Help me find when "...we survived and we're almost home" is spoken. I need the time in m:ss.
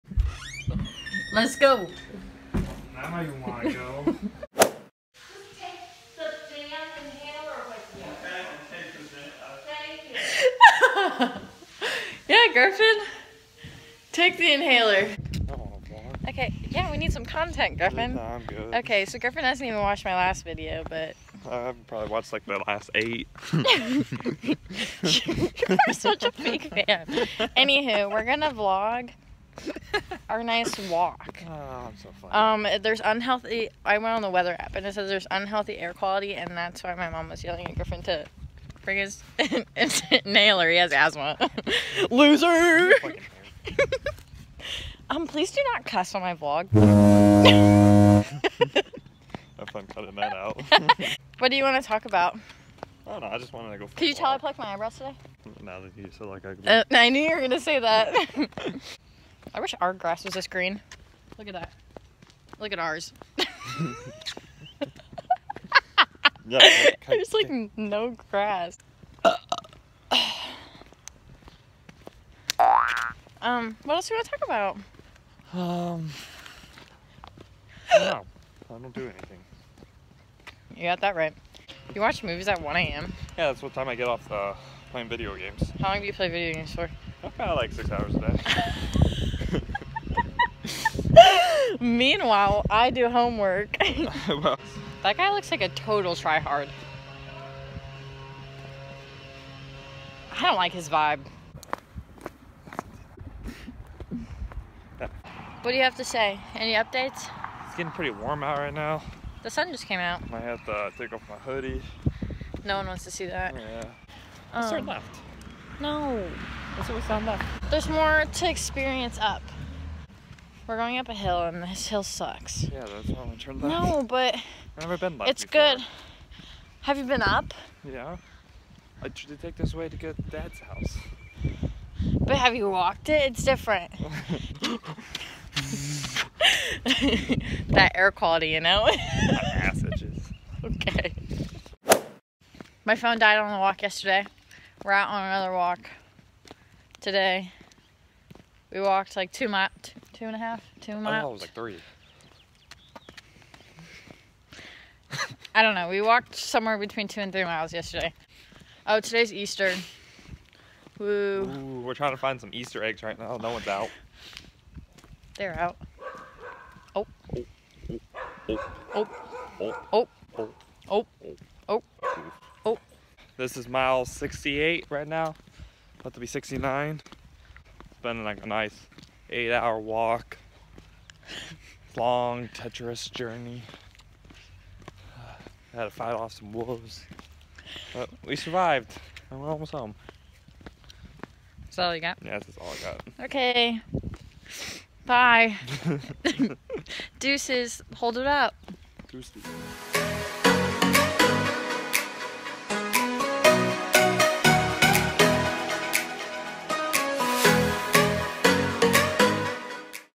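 3:08.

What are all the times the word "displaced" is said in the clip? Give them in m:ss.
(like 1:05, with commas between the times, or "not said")
not said.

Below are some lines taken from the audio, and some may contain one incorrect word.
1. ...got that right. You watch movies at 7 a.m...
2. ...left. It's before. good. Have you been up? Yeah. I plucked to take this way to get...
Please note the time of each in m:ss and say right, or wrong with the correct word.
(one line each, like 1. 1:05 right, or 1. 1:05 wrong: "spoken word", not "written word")
1. 1:20 wrong: "1", not "7"
2. 2:05 wrong: "tried", not "plucked".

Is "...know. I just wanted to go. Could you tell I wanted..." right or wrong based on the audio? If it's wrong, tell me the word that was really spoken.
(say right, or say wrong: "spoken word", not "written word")
wrong: "plucked", not "wanted".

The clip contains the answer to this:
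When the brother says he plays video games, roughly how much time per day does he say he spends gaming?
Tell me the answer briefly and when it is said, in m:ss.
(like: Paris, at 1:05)
6 hours a day, at 1:27.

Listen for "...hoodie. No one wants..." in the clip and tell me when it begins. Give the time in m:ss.
1:51.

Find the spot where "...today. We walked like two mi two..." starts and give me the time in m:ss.
2:26.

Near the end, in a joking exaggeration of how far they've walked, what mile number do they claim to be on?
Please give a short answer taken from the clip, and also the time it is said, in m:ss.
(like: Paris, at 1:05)
68, at 2:54.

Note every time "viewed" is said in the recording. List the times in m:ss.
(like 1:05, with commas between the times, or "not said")
not said.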